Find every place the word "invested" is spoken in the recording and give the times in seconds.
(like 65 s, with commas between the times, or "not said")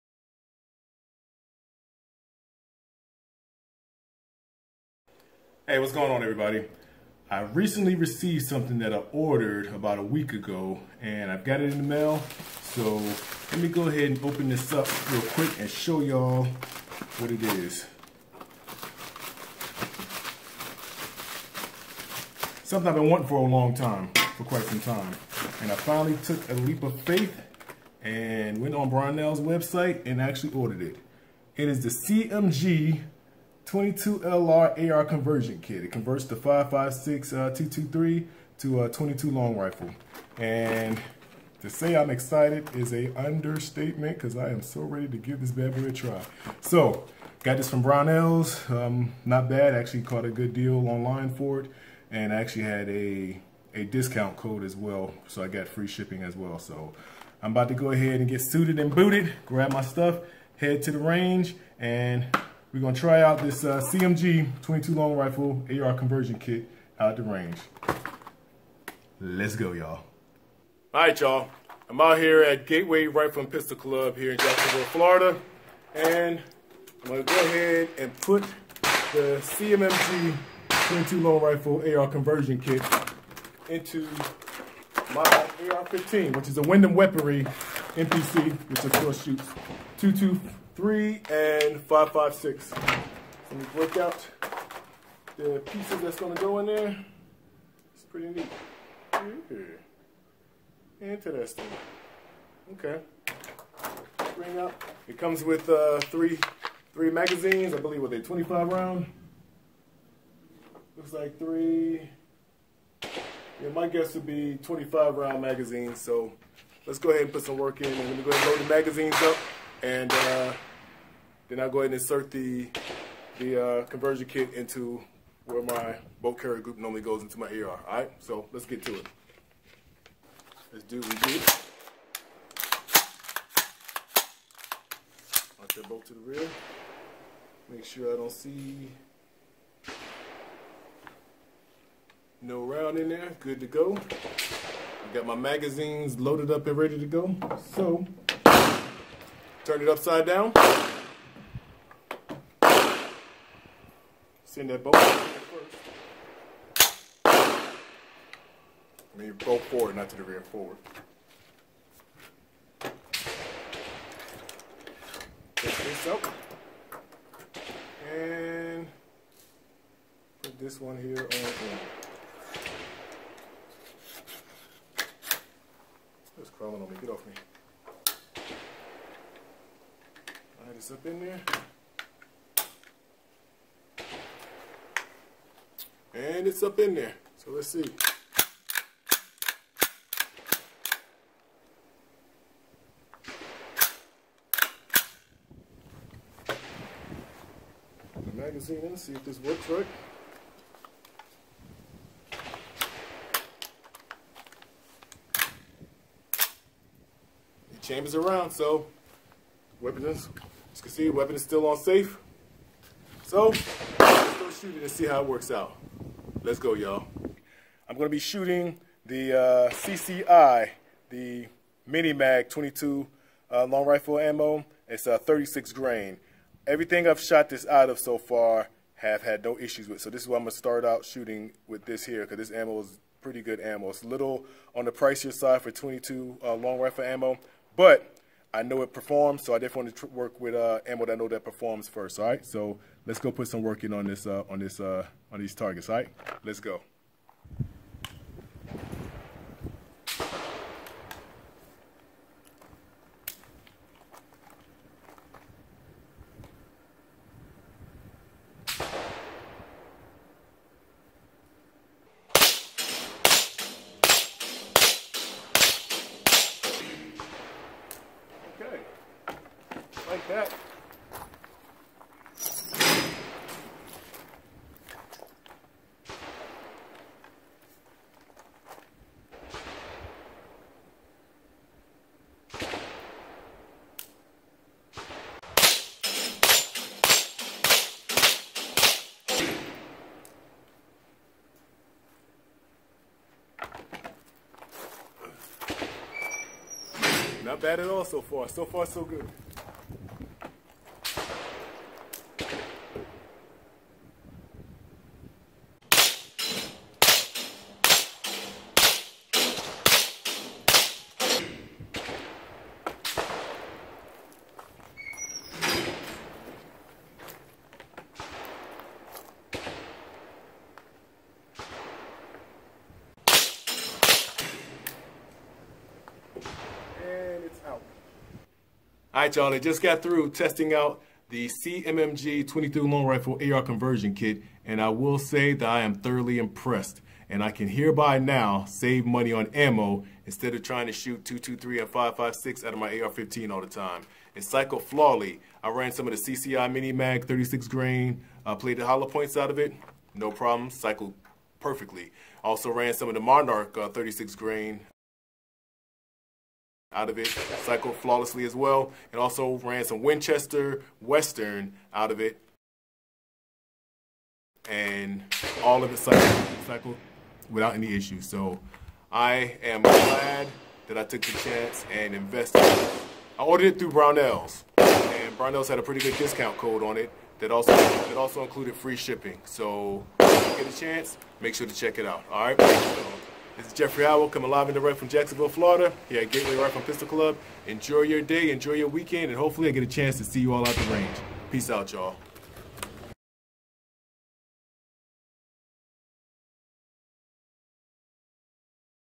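372 s.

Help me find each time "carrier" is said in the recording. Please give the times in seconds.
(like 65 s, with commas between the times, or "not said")
126 s.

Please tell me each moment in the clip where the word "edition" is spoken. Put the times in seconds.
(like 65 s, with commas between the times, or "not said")
not said.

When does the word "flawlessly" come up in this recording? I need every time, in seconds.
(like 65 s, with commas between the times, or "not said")
344 s, 357 s.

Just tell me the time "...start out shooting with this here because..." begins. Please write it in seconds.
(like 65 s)
230 s.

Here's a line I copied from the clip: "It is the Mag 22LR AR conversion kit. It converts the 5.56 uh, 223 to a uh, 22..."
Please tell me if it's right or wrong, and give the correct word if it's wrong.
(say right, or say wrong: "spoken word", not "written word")
wrong: "CMMG", not "Mag".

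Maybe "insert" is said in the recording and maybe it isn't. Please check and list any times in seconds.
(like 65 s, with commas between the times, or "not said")
121 s.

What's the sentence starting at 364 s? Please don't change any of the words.
And all of it cycled, cycled without any issues.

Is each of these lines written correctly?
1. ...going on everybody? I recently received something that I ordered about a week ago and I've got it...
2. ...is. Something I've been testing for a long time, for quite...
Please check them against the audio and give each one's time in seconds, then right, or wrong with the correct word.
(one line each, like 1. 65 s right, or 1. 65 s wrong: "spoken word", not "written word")
1. 5 s right
2. 17 s wrong: "wanting", not "testing".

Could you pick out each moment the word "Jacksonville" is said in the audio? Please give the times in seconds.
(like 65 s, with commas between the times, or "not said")
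74 s, 385 s.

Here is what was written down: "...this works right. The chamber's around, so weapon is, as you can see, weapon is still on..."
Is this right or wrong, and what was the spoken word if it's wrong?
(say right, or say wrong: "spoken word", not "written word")
right.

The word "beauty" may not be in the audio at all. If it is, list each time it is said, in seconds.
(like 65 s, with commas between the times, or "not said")
not said.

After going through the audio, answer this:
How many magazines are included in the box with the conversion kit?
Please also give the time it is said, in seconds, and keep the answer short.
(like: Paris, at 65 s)
3, at 106 s.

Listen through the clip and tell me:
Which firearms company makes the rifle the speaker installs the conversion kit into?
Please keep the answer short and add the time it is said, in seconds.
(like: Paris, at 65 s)
Windham Weaponry, at 86 s.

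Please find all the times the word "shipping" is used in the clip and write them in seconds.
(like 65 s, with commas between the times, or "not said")
55 s, 378 s.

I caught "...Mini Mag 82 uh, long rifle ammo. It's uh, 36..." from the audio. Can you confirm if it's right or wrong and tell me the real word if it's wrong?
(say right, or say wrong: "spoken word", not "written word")
wrong: "22", not "82".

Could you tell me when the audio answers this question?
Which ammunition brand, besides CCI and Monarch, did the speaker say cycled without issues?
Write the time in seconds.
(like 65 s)
360 s.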